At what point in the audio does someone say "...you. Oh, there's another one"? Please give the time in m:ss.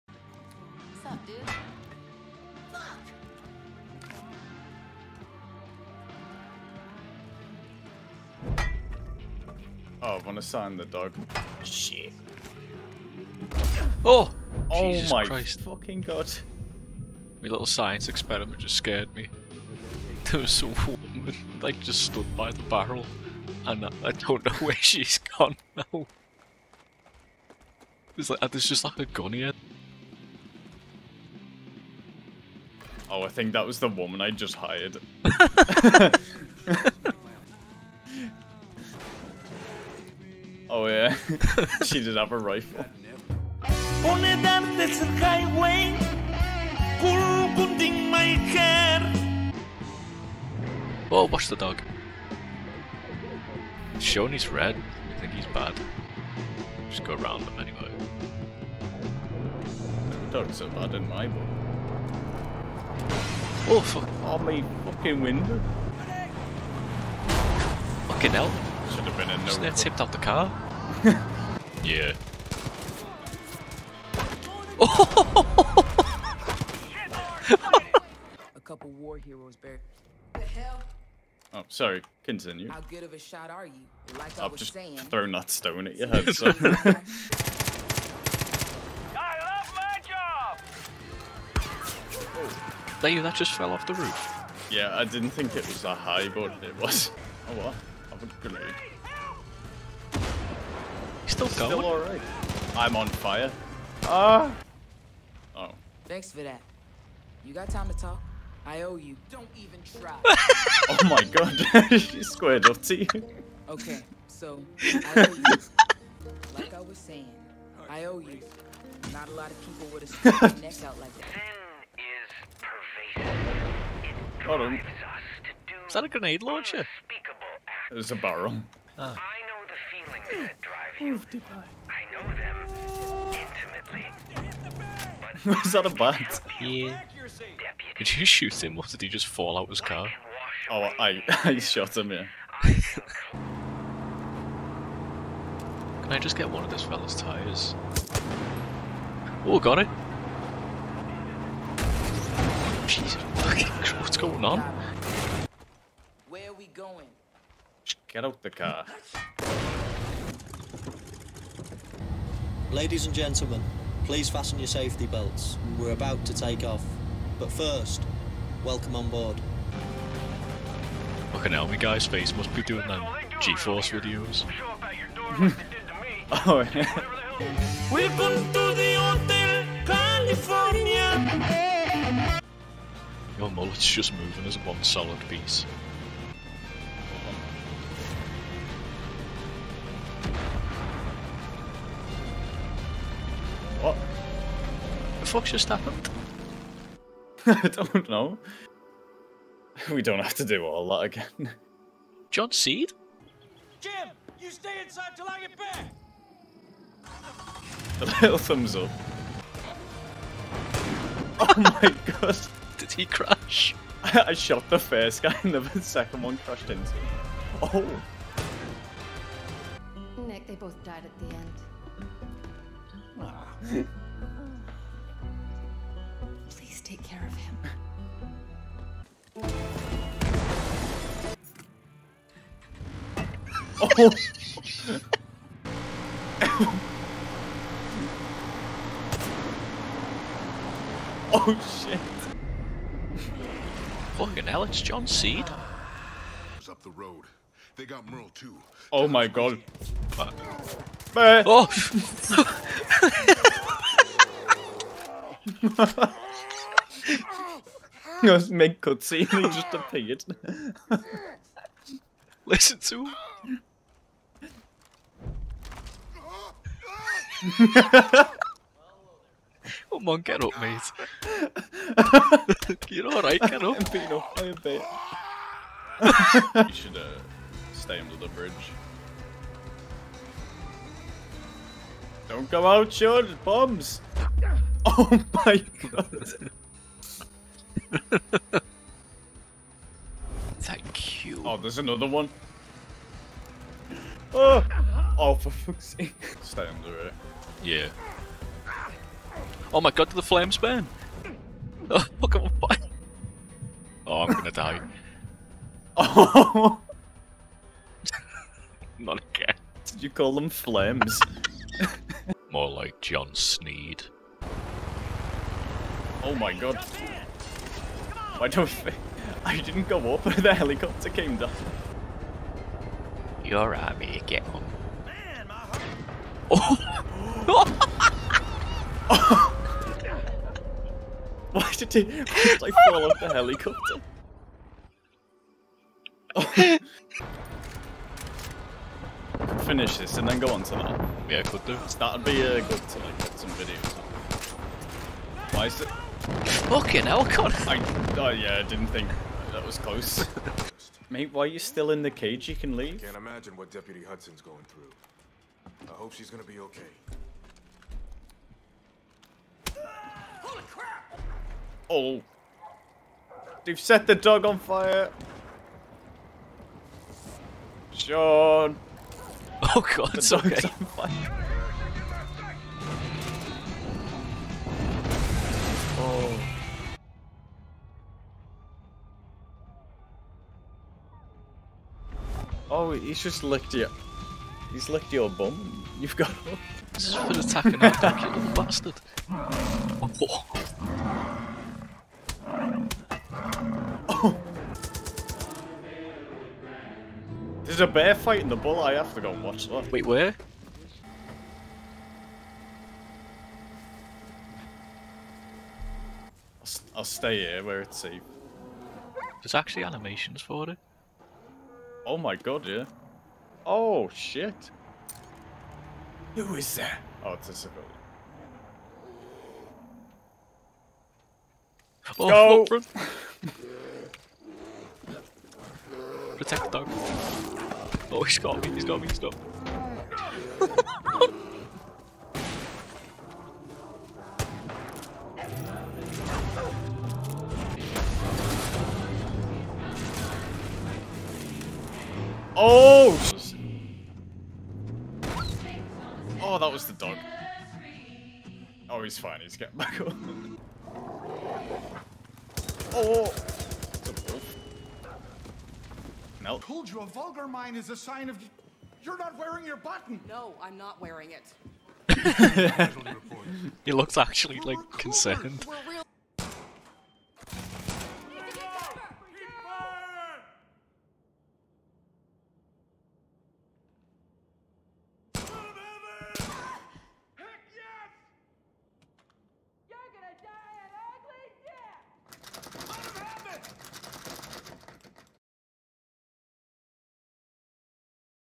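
4:51.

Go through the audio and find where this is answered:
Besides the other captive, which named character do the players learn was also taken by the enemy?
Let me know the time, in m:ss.
4:08.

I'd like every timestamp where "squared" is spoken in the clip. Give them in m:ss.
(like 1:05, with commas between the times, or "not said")
1:52.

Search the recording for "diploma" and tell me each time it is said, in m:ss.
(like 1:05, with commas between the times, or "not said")
not said.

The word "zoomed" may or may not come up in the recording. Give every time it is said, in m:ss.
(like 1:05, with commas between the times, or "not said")
not said.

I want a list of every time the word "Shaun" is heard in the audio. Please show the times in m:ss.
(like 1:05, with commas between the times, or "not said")
4:42, 6:07.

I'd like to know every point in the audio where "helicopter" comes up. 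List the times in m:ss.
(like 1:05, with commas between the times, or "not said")
5:20, 5:33.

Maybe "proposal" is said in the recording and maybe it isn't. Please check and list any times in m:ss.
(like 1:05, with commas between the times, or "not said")
not said.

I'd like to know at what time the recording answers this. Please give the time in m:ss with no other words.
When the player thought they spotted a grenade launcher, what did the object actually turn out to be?
2:07.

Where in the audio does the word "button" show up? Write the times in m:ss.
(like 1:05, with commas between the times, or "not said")
7:39.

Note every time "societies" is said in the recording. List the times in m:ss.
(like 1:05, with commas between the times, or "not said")
not said.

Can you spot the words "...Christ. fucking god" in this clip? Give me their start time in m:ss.
0:15.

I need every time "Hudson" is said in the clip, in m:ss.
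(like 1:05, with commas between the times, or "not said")
5:54.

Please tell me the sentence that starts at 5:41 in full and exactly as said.
That'd be uh, good to like get some videos.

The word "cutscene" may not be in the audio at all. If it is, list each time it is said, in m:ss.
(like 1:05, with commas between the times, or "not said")
4:18.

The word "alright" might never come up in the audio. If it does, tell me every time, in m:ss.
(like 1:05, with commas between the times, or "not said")
1:41, 4:33.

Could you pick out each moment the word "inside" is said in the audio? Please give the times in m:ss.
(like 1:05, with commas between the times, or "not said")
3:24.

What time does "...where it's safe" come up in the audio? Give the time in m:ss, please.
6:47.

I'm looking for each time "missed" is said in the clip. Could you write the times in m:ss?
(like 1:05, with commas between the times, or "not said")
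not said.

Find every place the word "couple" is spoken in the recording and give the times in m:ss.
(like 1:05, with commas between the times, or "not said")
1:18.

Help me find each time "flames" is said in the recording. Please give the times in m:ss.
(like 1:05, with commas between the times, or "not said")
5:00, 5:10.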